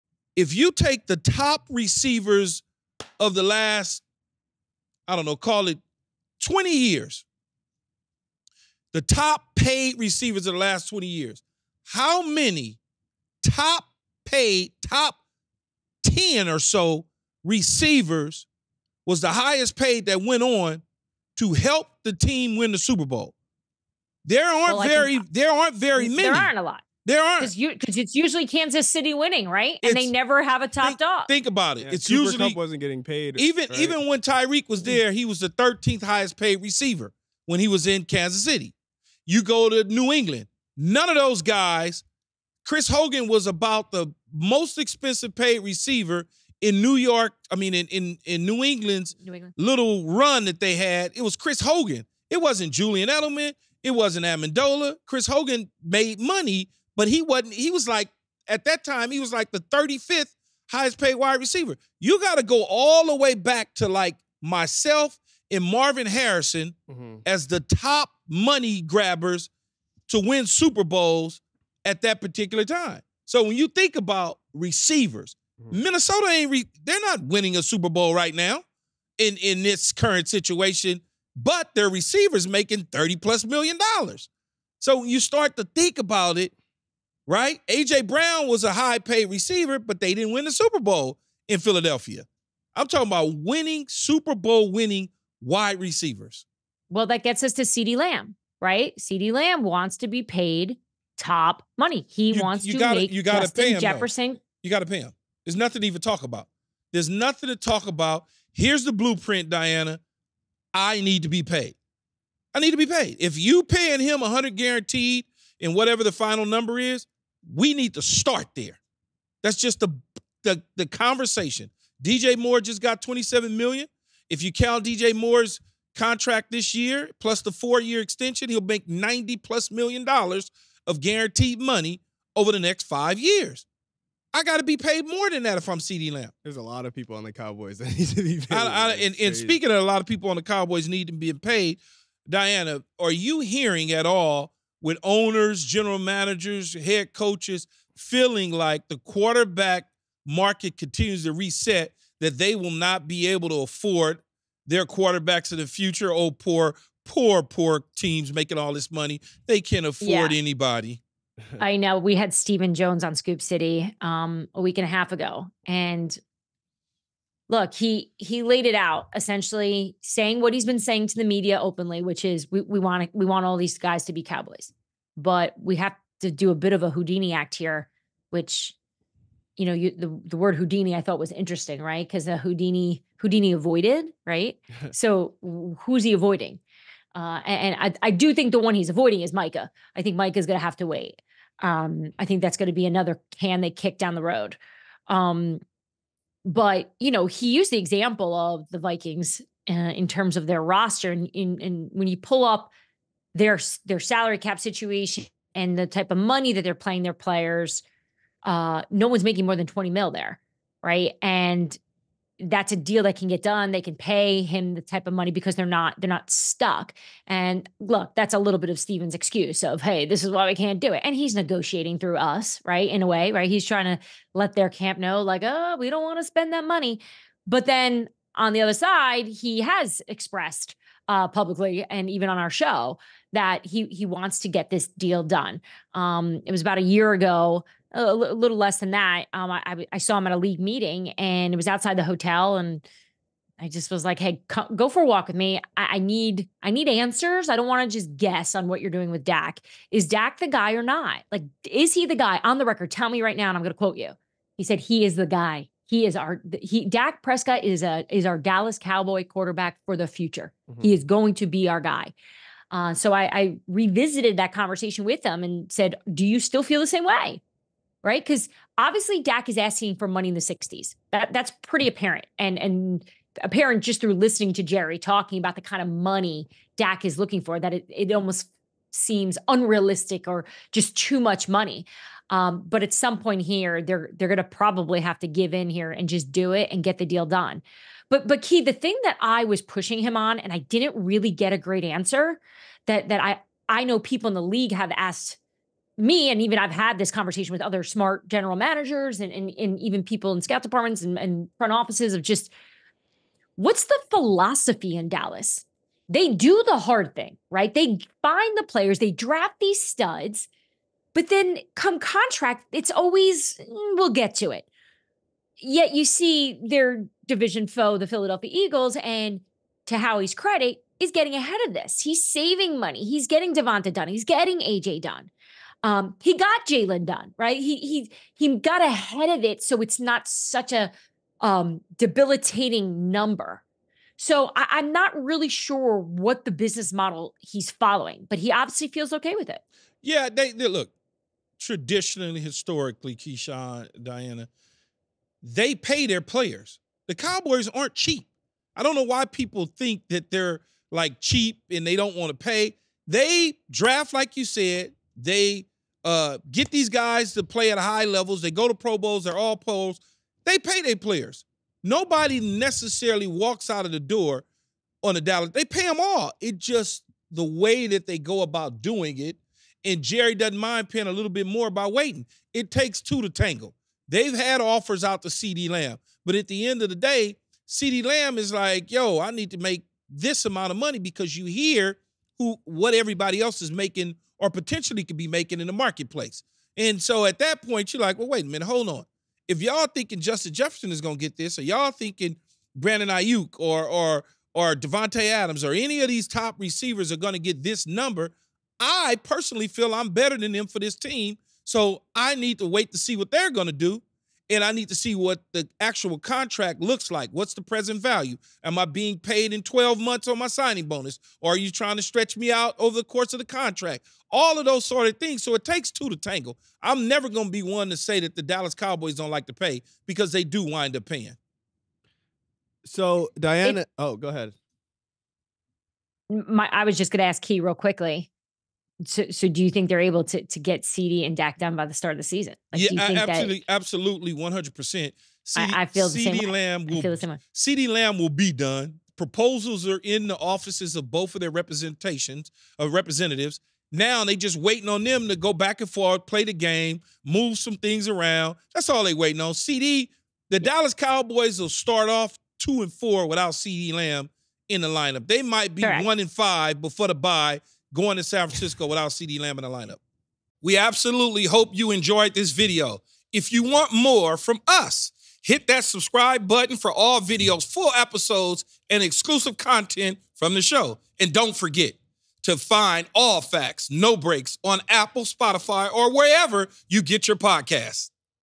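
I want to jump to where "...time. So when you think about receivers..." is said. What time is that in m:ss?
1:12.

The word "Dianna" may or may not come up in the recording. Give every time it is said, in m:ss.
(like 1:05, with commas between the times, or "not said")
1:49, 2:22, 5:43, 7:03.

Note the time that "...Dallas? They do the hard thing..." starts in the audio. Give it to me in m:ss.
5:05.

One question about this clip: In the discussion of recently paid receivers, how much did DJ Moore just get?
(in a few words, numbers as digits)
27 million.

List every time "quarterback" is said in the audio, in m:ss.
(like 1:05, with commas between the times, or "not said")
2:28, 2:34, 4:19.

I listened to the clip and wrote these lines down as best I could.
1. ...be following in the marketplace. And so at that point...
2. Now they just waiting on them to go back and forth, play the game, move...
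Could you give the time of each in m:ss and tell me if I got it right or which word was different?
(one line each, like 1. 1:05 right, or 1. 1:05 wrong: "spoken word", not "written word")
1. 6:25 wrong: "making", not "following"
2. 7:23 right.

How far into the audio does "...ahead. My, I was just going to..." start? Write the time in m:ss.
7:04.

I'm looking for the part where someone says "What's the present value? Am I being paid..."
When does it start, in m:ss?
6:47.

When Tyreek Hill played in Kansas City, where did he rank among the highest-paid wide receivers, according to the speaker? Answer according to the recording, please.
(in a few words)
13th.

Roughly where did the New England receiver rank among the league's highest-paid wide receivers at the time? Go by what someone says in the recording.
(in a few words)
35th.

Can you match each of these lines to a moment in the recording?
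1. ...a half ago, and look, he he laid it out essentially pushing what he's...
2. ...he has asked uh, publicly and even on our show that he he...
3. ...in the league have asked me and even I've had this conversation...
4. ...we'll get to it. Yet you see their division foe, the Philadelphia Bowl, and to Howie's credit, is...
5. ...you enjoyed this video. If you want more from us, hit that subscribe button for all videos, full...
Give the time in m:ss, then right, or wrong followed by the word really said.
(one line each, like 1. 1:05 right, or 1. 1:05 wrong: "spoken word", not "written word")
1. 2:44 wrong: "saying", not "pushing"
2. 3:49 wrong: "expressed", not "asked"
3. 4:54 right
4. 5:13 wrong: "Eagles", not "Bowl"
5. 7:41 right.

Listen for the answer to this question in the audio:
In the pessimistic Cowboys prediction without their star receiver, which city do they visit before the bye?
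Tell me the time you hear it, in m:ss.
7:38.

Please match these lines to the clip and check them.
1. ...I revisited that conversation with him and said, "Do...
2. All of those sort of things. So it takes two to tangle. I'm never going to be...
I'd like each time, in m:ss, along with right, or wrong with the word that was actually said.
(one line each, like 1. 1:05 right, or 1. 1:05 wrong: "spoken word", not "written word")
1. 4:23 right
2. 6:54 right.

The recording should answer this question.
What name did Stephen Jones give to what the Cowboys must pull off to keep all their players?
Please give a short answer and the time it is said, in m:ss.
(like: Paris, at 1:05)
Houdini act, at 2:56.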